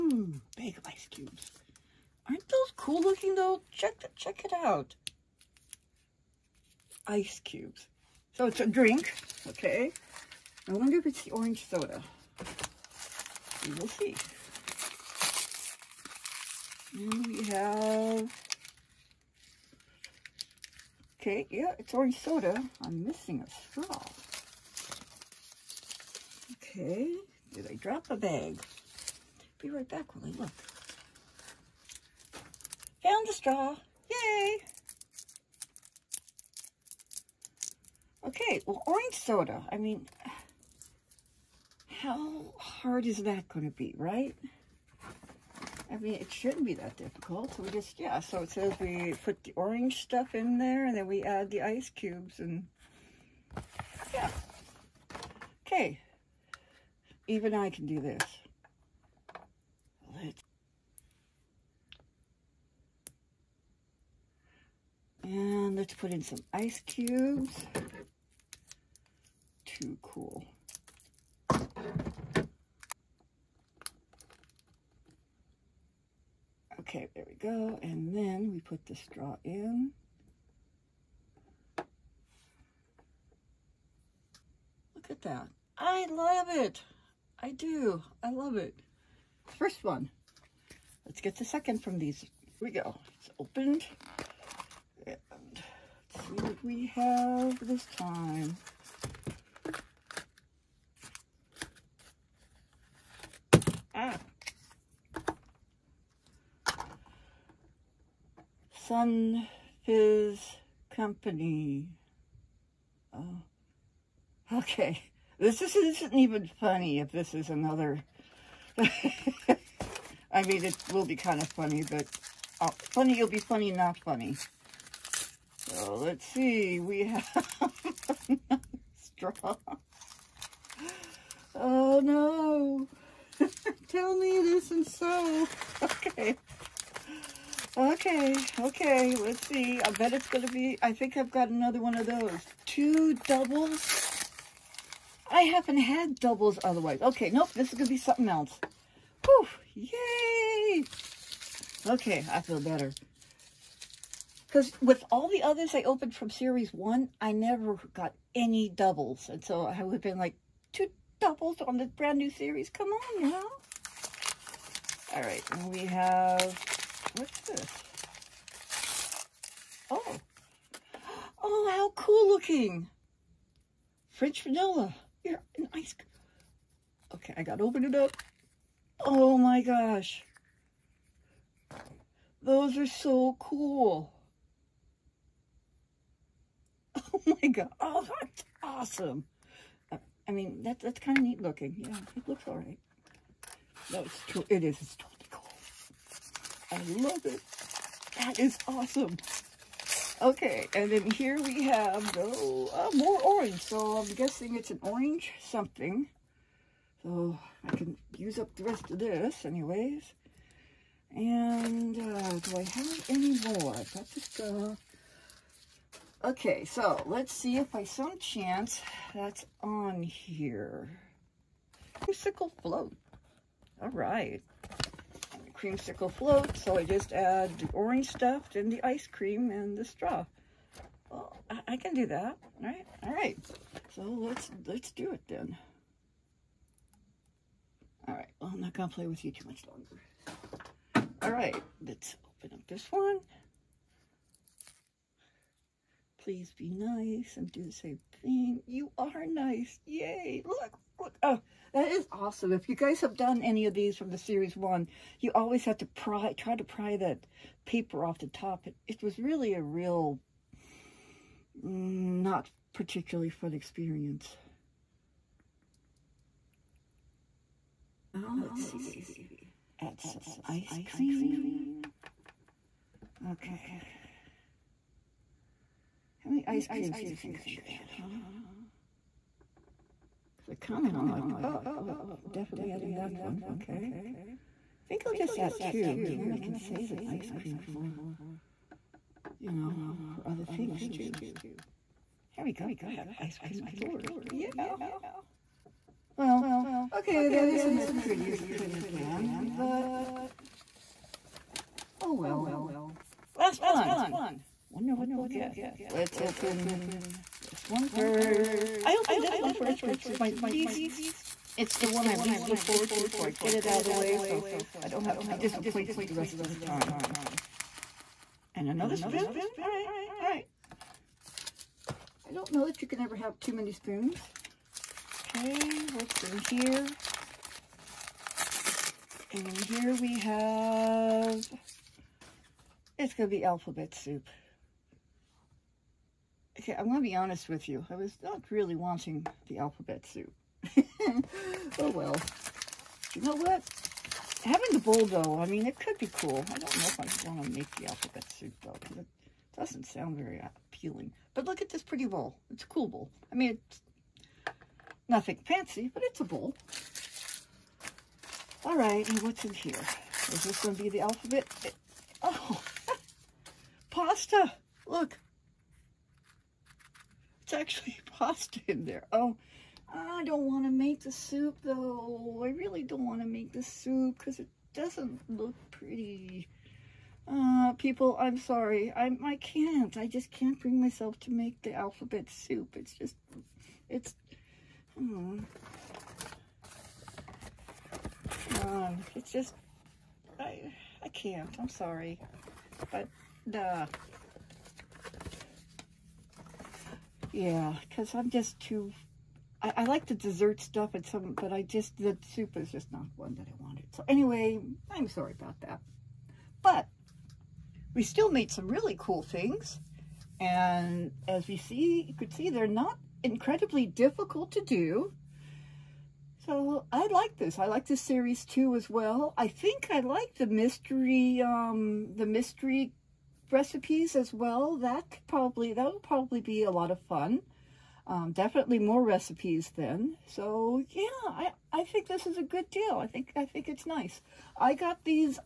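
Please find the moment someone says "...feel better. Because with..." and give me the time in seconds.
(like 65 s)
152 s.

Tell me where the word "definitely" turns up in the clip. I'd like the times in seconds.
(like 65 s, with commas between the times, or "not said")
282 s, 428 s.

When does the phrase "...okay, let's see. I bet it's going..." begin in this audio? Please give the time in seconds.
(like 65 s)
138 s.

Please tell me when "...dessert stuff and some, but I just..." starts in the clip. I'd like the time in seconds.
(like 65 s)
400 s.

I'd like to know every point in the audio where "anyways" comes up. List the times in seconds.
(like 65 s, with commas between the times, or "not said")
209 s, 404 s.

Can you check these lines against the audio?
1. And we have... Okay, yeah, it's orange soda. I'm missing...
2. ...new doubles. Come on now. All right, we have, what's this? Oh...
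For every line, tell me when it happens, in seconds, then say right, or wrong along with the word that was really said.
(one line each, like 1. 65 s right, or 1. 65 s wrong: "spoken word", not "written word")
1. 16 s right
2. 162 s wrong: "series", not "doubles".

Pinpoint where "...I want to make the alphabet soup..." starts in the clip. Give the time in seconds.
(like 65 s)
346 s.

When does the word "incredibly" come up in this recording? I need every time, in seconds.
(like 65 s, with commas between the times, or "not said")
413 s.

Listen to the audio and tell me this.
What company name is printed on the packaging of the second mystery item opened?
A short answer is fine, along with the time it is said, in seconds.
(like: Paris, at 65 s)
Sun Fizz Company, at 108 s.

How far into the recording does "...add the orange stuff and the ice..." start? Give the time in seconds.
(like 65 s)
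227 s.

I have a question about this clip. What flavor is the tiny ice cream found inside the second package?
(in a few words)
French vanilla.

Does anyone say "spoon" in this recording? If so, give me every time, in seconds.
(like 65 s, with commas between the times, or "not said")
318 s, 323 s.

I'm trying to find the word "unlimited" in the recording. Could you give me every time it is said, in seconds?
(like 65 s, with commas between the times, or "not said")
not said.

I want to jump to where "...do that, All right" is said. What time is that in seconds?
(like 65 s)
231 s.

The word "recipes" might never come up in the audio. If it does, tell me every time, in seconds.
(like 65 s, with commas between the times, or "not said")
423 s, 429 s.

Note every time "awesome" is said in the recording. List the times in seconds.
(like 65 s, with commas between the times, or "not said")
188 s, 198 s, 252 s.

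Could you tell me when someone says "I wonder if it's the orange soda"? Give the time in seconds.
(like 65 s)
10 s.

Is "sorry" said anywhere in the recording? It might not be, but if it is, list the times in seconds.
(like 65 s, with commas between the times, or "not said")
378 s, 391 s, 405 s.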